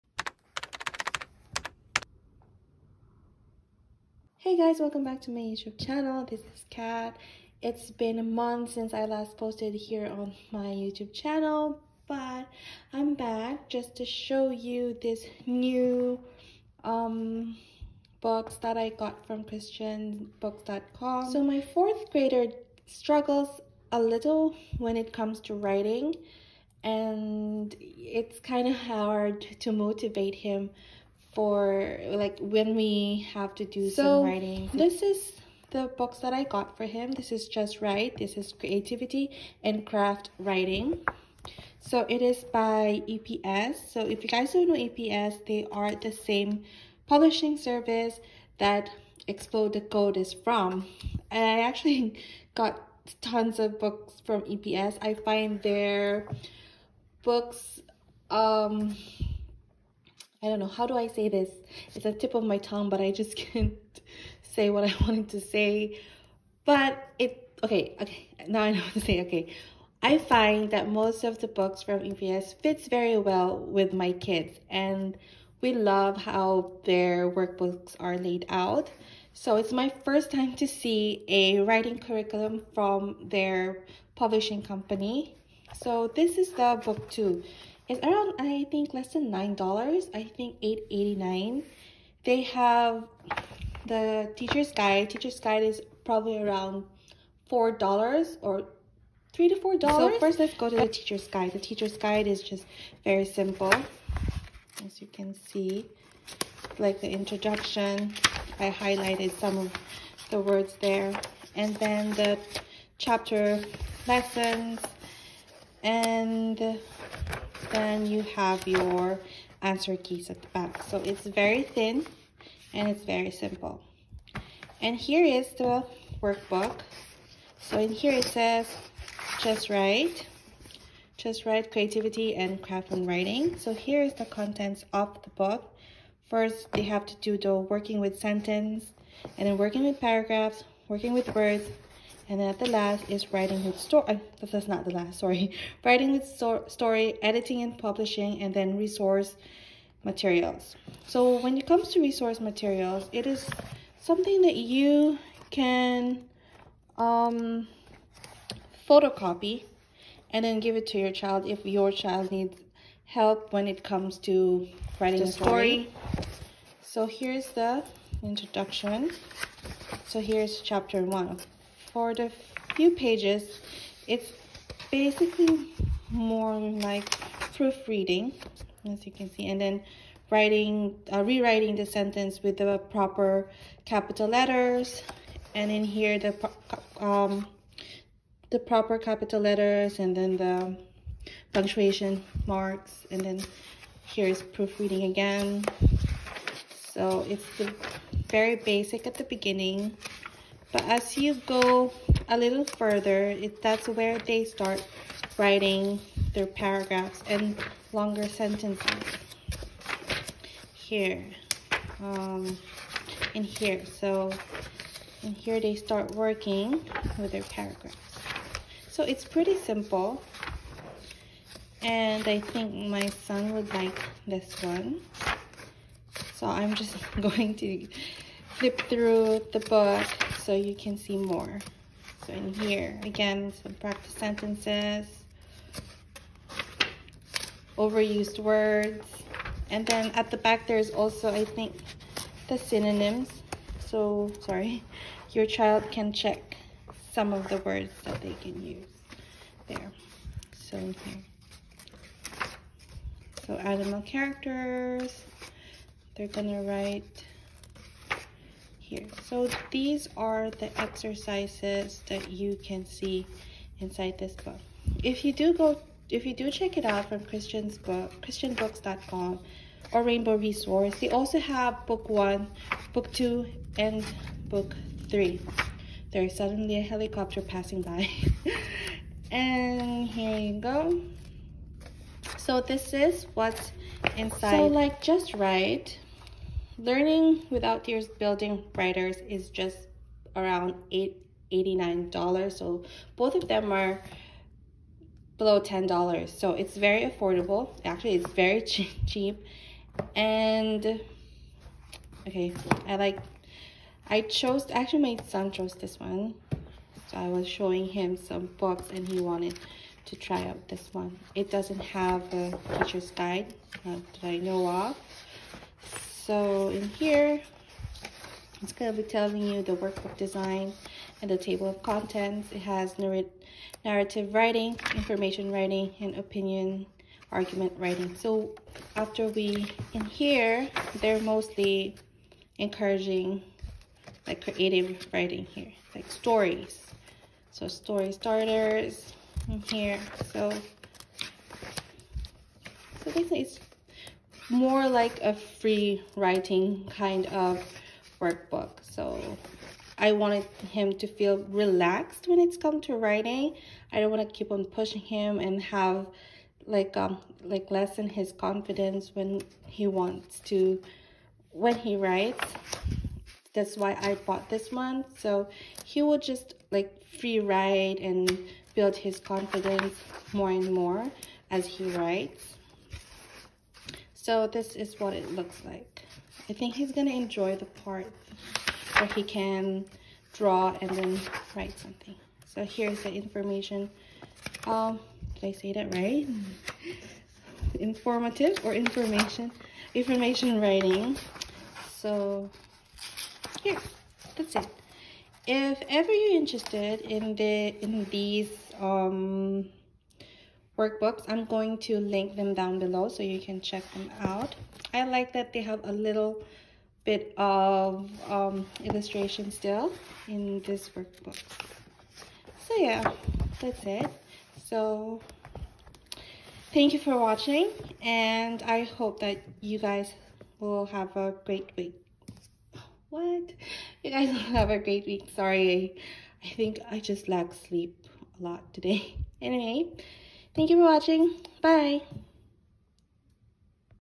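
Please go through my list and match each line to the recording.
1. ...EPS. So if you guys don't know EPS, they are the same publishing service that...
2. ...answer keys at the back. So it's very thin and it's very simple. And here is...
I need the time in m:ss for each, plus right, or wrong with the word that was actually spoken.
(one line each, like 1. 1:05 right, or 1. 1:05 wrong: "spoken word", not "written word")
1. 0:43 right
2. 1:59 right.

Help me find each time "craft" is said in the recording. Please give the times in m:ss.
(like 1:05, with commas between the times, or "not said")
0:39, 2:12.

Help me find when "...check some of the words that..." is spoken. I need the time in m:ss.
4:06.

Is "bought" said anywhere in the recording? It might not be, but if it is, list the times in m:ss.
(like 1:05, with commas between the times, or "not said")
6:04.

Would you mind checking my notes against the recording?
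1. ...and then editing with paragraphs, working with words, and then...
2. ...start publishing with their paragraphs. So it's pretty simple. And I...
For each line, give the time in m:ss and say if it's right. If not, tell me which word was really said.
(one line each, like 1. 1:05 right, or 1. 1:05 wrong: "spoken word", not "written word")
1. 2:19 wrong: "working", not "editing"
2. 3:35 wrong: "working", not "publishing".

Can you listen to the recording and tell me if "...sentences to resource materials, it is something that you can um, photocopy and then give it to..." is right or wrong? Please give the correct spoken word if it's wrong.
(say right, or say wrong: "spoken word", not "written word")
wrong: "comes", not "sentences".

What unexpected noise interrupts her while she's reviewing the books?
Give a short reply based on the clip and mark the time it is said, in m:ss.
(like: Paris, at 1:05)
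A helicopter, at 4:36.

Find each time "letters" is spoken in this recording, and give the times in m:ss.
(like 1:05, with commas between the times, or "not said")
3:04, 3:09.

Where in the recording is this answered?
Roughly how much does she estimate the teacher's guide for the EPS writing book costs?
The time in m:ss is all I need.
1:39.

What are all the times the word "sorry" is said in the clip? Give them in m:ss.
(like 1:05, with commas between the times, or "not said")
2:25, 4:04, 7:05.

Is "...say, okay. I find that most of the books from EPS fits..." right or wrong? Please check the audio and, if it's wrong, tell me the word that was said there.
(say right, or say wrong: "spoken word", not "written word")
right.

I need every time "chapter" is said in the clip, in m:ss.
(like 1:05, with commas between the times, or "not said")
1:52, 2:50.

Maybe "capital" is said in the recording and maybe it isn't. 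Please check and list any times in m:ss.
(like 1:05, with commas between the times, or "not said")
3:03, 3:08.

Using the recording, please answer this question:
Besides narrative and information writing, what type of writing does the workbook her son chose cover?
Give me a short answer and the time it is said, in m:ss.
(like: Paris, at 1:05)
Opinion argument writing, at 5:26.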